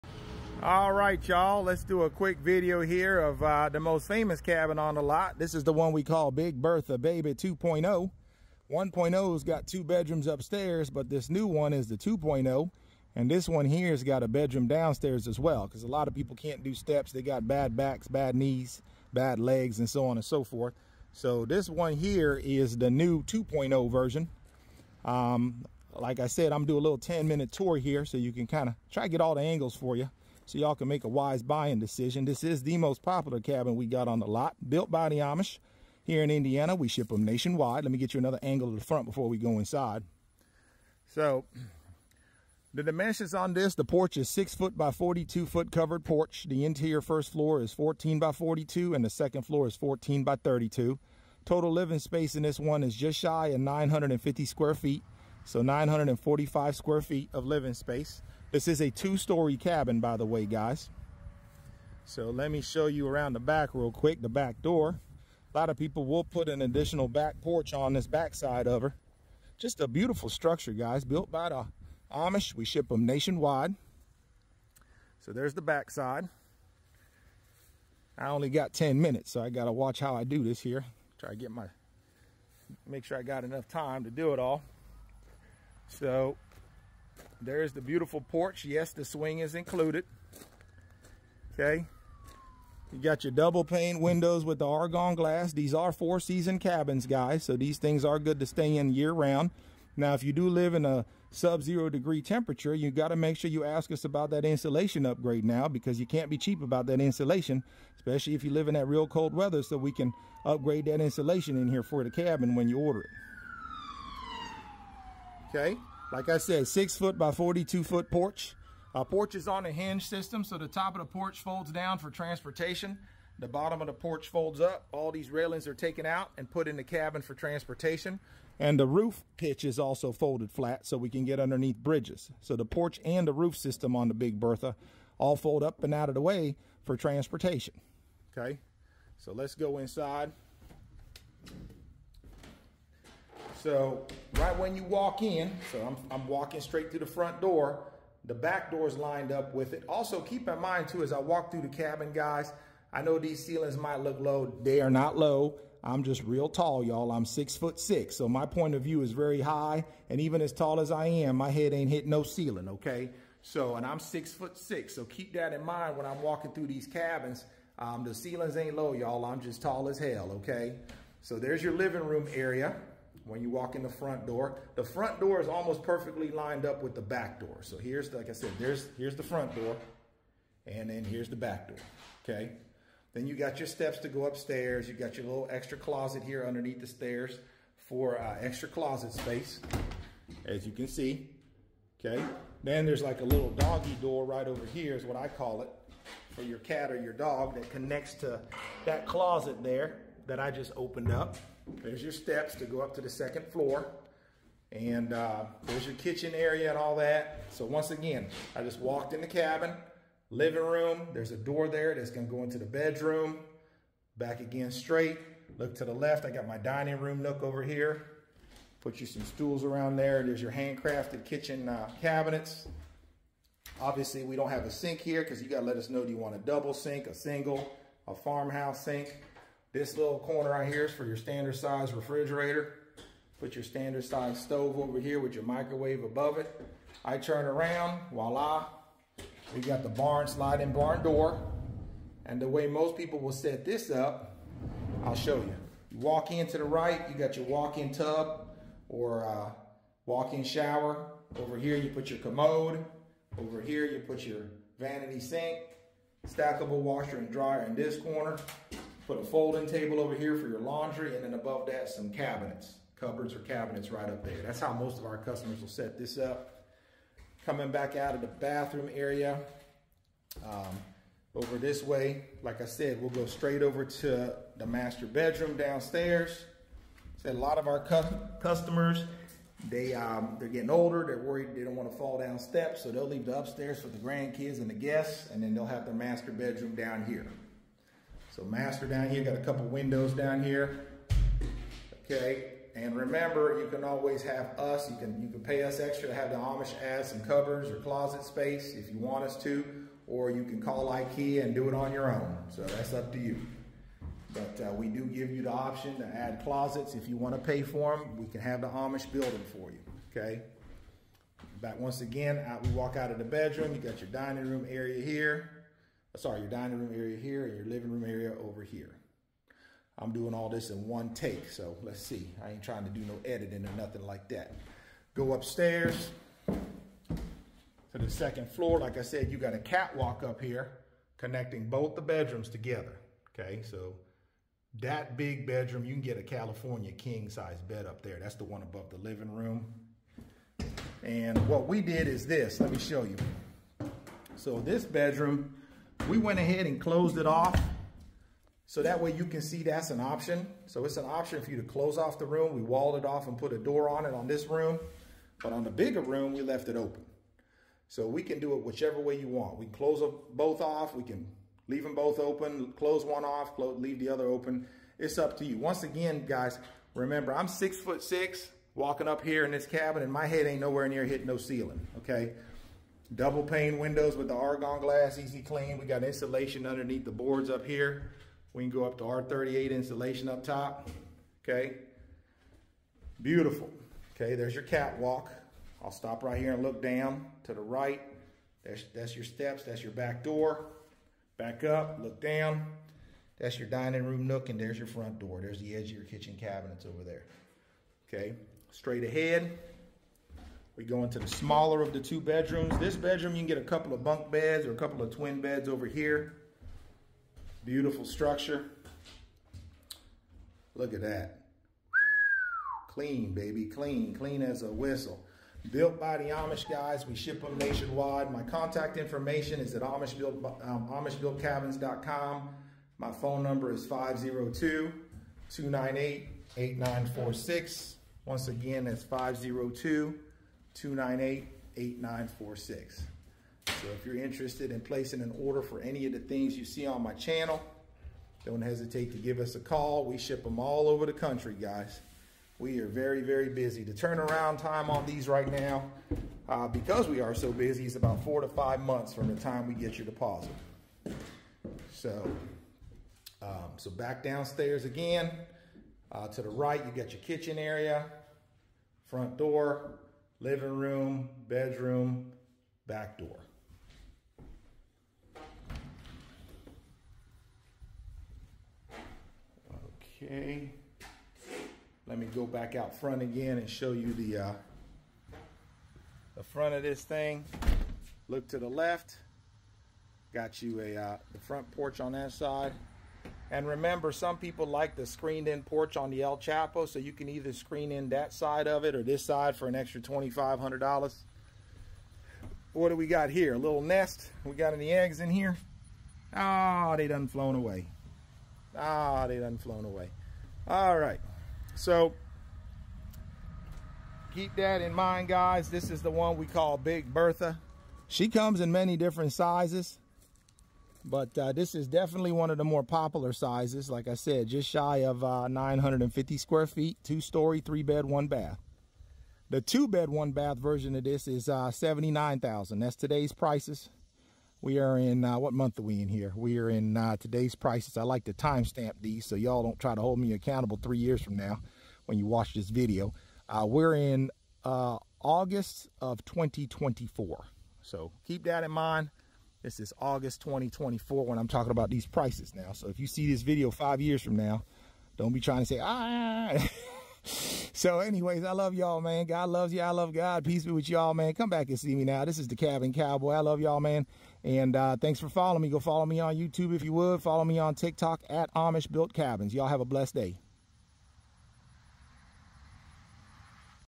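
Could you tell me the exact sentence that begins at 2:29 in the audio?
Also keep in mind too, as I walk through the cabin, guys, I know these ceilings might look low.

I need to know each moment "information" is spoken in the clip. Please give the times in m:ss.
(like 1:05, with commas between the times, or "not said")
6:58.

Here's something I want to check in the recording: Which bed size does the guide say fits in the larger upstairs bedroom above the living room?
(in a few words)
California king.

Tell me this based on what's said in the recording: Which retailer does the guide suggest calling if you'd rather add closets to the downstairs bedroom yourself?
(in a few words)
Ikea.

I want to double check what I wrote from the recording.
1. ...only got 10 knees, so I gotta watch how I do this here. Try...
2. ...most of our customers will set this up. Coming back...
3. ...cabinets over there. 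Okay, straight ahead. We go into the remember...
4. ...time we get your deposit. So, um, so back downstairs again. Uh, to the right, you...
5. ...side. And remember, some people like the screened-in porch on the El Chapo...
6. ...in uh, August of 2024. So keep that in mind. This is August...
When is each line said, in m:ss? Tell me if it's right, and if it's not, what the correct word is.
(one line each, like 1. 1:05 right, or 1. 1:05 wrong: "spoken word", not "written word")
1. 1:18 wrong: "minutes", not "knees"
2. 4:24 right
3. 6:36 wrong: "smaller", not "remember"
4. 7:29 right
5. 8:02 right
6. 8:53 right.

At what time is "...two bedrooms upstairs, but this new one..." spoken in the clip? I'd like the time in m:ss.
0:09.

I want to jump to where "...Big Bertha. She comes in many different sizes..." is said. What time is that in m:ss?
8:26.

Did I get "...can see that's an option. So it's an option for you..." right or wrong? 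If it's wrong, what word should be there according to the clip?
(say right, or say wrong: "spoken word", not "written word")
right.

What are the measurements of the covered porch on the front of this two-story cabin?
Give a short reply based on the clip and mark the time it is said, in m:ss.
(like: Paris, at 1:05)
6 by 42 feet, at 0:44.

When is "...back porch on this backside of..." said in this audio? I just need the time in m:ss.
1:07.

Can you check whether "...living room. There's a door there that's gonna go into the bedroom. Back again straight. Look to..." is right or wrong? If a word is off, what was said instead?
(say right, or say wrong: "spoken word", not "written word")
right.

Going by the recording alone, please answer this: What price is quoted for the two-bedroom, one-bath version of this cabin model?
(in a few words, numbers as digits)
$79,000.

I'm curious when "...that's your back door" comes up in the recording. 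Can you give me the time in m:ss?
6:29.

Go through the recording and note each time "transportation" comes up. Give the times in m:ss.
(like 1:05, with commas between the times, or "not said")
2:02, 2:07, 2:16.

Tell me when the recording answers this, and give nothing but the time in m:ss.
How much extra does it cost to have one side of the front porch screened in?
8:10.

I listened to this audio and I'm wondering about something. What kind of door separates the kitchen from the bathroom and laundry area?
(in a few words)
sliding barn door.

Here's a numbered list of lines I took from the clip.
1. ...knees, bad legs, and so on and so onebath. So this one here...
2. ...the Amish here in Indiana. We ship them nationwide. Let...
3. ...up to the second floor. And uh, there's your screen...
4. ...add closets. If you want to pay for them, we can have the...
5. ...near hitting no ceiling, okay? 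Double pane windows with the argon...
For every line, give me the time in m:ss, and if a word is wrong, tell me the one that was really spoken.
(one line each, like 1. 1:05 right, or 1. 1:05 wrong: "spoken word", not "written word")
1. 0:18 wrong: "forth", not "onebath"
2. 0:35 right
3. 3:22 wrong: "kitchen", not "screen"
4. 5:06 right
5. 6:10 right.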